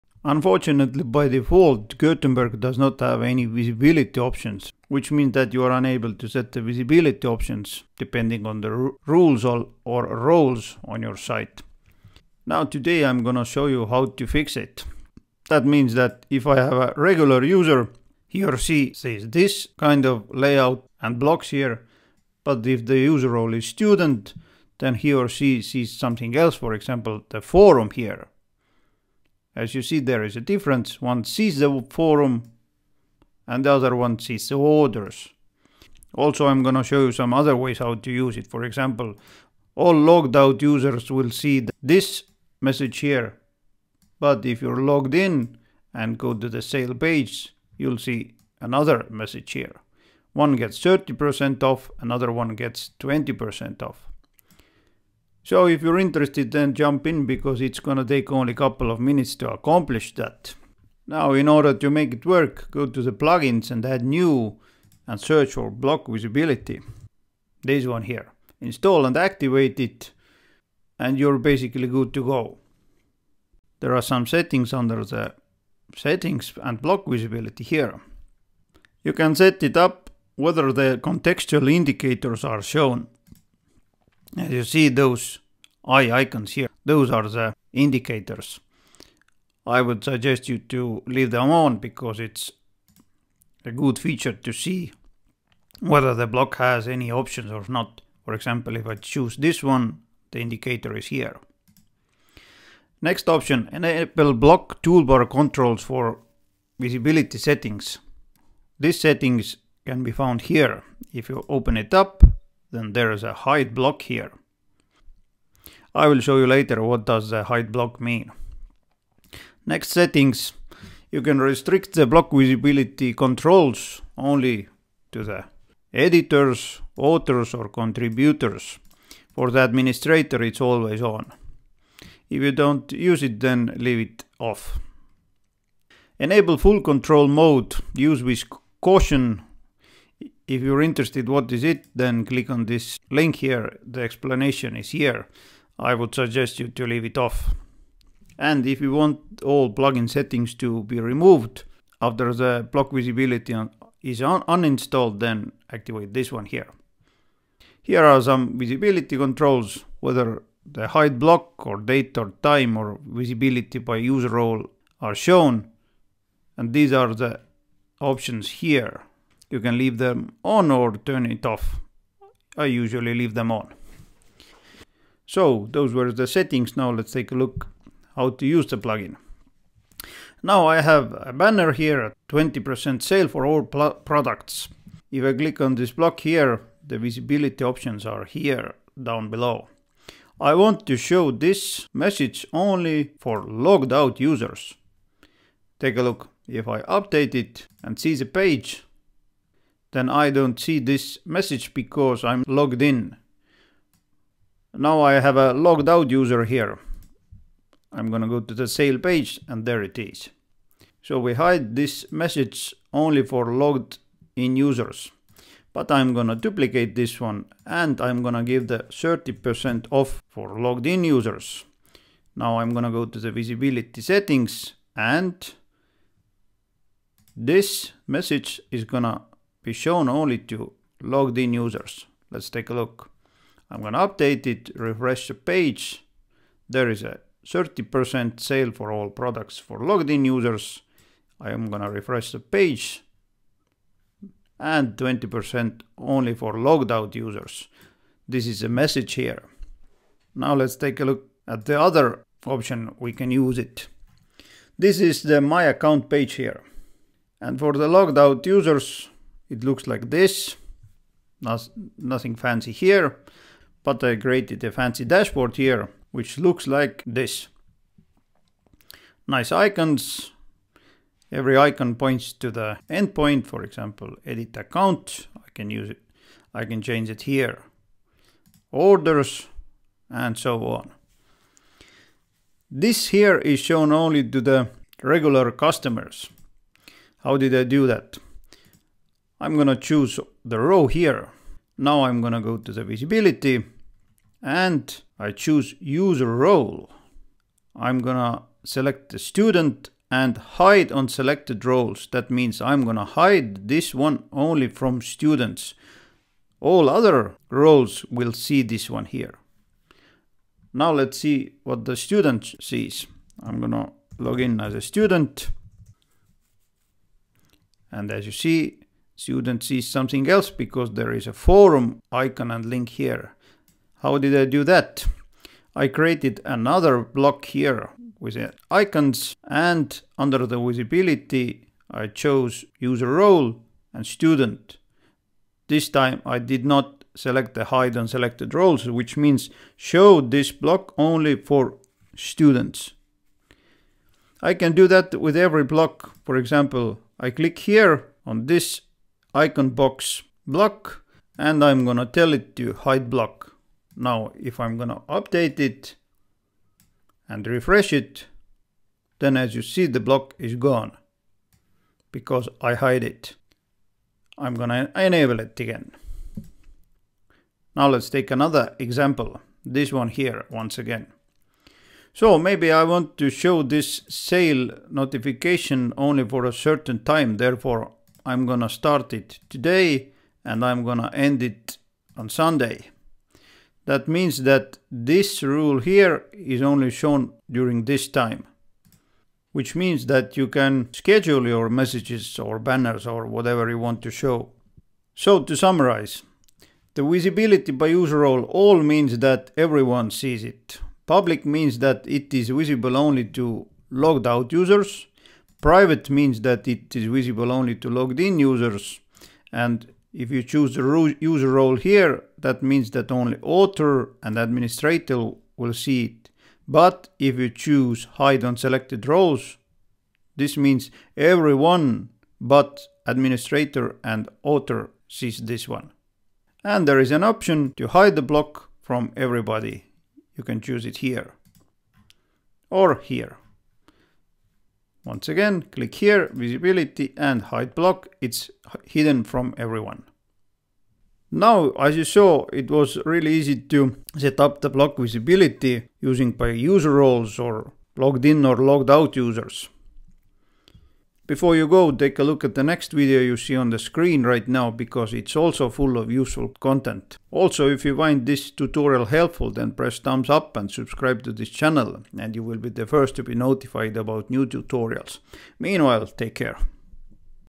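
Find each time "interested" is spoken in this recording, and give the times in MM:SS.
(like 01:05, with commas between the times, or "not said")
00:55, 02:20.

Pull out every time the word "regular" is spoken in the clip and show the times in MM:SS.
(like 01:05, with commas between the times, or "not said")
00:16, 04:45.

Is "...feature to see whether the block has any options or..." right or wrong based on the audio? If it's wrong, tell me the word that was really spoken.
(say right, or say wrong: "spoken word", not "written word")
right.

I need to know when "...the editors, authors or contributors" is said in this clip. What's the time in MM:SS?
02:05.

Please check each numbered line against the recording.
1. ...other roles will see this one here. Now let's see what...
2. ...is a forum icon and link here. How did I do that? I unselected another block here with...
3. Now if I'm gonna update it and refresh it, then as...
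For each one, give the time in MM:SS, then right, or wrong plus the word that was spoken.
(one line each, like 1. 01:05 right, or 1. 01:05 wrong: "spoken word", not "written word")
1. 05:06 right
2. 05:21 wrong: "created", not "unselected"
3. 05:53 right.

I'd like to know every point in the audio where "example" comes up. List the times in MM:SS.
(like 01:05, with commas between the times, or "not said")
00:26, 00:38, 01:38, 04:33, 05:46, 06:08.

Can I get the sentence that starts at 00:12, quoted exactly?
Now today I'm gonna show you how to fix it.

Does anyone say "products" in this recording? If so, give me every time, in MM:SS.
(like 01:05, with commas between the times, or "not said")
03:03, 03:59.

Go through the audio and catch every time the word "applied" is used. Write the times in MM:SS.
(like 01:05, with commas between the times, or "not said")
not said.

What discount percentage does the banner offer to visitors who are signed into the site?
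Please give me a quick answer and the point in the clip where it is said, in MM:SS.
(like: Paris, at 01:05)
30%, at 03:38.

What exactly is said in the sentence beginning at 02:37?
Here are some visibility controls, whether the hide block or date or time or visibility by user role are shown.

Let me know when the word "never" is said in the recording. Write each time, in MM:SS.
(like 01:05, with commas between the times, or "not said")
not said.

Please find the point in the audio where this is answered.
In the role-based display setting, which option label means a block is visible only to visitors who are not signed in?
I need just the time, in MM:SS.
06:41.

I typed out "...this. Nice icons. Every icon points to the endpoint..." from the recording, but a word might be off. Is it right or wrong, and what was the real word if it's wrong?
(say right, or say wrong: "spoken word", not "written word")
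right.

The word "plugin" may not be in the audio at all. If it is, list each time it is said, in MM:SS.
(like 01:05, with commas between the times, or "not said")
01:03, 02:29, 02:58.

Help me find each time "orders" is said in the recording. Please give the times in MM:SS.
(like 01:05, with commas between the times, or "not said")
00:34, 01:01, 04:38.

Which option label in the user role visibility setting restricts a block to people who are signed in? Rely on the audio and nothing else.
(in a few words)
Private.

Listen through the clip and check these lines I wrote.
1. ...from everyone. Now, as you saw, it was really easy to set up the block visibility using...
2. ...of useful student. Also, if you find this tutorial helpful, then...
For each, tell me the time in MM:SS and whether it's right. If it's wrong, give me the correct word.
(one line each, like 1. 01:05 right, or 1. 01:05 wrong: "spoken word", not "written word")
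1. 07:19 right
2. 07:35 wrong: "content", not "student".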